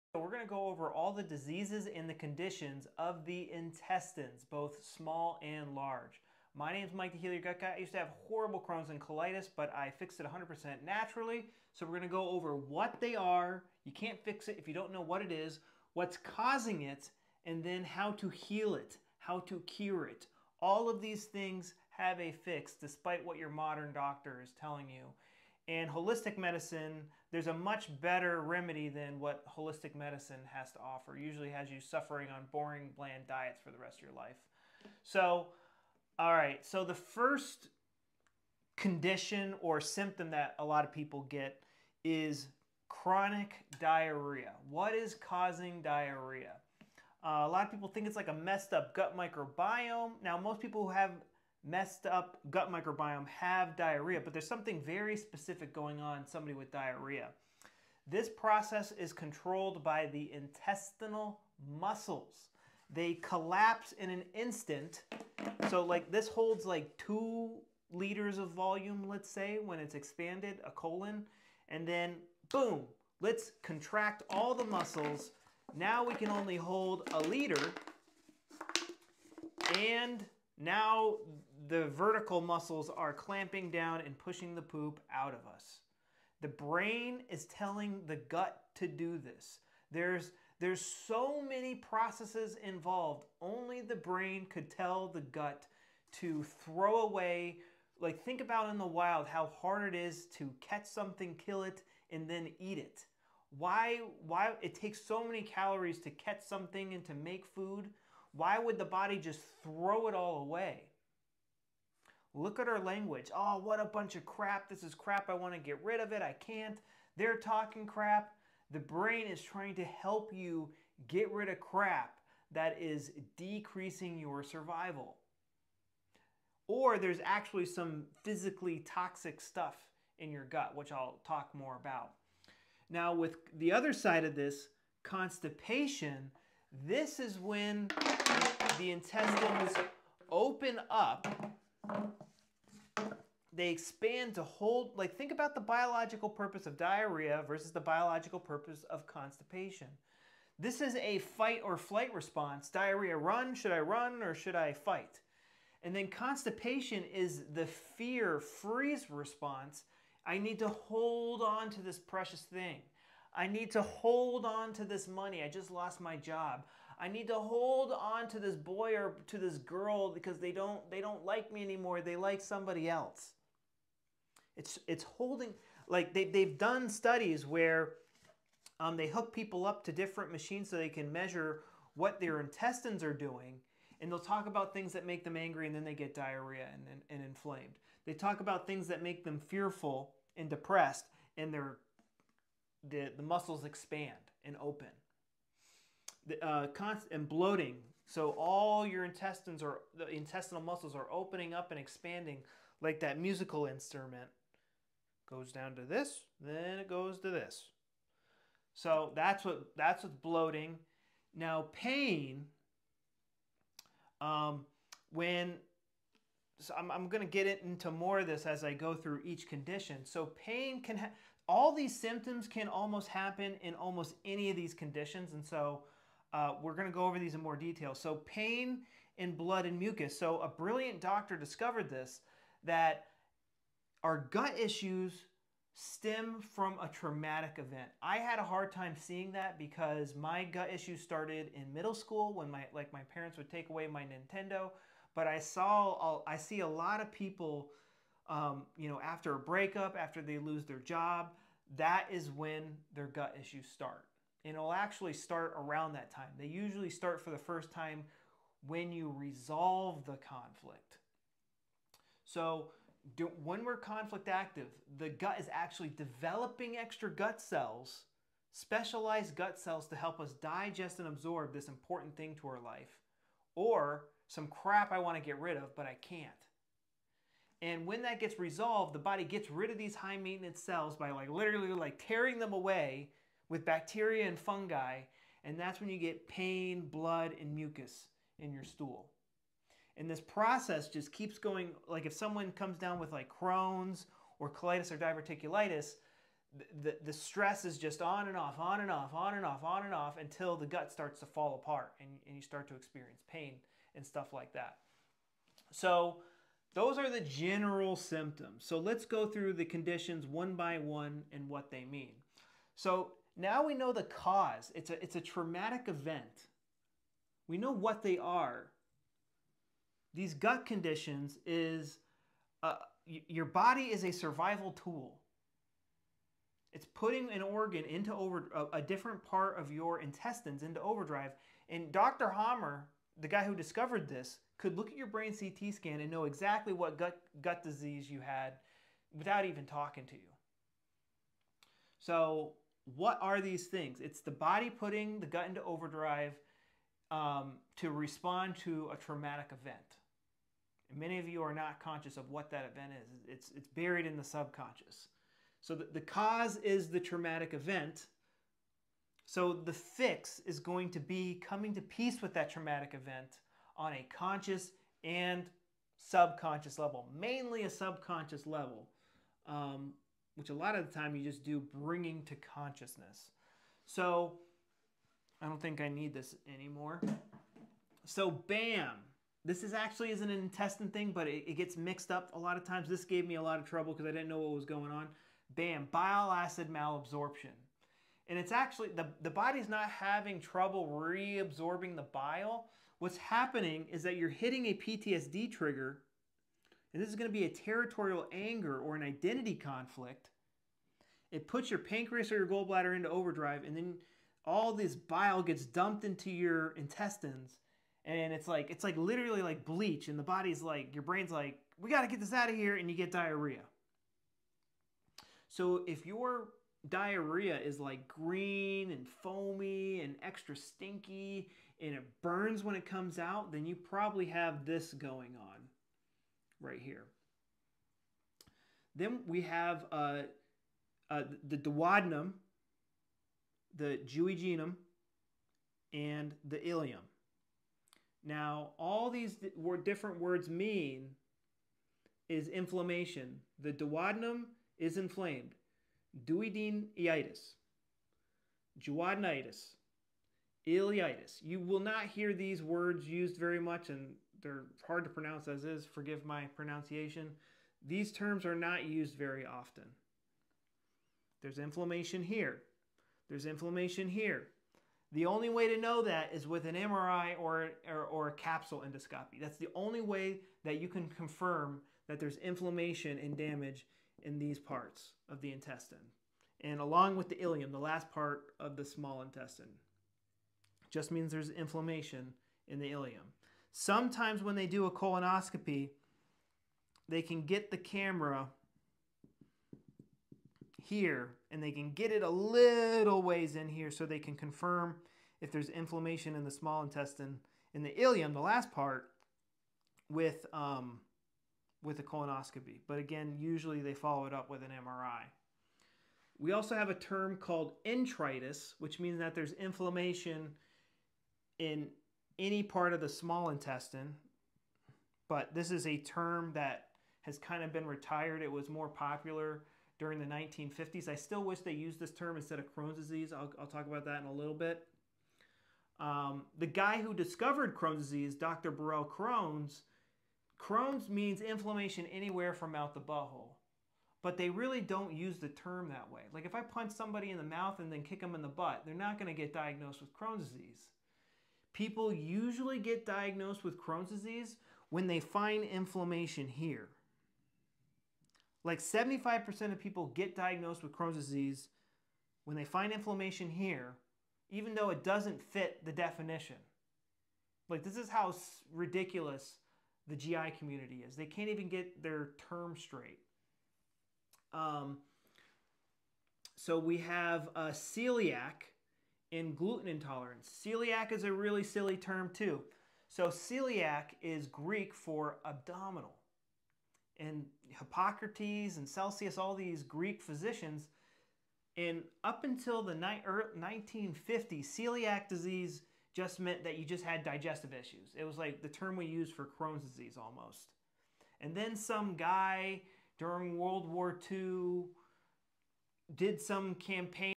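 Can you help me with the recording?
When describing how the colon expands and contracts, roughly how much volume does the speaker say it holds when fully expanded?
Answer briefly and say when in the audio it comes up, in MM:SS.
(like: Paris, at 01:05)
2 liters, at 01:06.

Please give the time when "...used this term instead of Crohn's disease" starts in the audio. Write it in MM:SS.
08:41.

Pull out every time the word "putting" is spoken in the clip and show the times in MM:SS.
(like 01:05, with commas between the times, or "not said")
05:26, 05:44.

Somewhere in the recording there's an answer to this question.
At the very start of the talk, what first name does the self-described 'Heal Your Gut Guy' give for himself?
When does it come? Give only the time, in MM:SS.
00:06.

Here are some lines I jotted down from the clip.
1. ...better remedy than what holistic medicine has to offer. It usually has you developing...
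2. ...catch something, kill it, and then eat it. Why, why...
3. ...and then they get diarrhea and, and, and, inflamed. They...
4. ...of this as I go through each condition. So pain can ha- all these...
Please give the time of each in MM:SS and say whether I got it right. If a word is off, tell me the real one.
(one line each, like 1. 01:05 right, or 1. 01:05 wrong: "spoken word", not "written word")
1. 00:28 wrong: "suffering", not "developing"
2. 01:40 right
3. 03:05 right
4. 03:38 right.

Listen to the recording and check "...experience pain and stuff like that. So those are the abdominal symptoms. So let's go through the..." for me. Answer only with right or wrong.
wrong.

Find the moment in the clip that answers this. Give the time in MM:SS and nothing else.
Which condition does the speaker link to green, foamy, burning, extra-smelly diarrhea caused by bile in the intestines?
06:25.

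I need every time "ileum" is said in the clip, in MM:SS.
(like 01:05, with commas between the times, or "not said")
07:16, 07:57, 08:02, 08:17.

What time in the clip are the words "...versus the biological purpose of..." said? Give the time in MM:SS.
02:27.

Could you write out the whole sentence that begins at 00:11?
So we're going to go over what they are.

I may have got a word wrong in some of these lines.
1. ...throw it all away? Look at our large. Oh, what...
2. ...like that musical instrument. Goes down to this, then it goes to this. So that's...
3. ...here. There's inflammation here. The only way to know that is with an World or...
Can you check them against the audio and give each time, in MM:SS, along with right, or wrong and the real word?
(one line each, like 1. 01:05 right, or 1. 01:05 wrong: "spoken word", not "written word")
1. 01:49 wrong: "language", not "large"
2. 03:22 right
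3. 07:42 wrong: "MRI", not "World".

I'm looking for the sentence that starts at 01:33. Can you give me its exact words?
Only the brain could tell the gut to throw away.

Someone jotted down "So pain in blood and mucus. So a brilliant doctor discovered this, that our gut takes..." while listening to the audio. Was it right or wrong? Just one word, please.
wrong.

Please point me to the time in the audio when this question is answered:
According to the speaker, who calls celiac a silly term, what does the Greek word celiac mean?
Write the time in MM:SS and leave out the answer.
09:35.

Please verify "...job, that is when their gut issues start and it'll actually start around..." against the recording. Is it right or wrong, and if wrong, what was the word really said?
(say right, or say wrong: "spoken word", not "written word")
right.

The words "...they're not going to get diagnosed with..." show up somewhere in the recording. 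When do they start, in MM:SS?
08:58.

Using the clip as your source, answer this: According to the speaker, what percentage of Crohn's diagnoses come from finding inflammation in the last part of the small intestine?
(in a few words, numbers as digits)
75%.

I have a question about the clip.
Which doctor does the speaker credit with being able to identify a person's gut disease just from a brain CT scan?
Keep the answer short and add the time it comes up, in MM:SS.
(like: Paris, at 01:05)
Dr. Hamer, at 05:31.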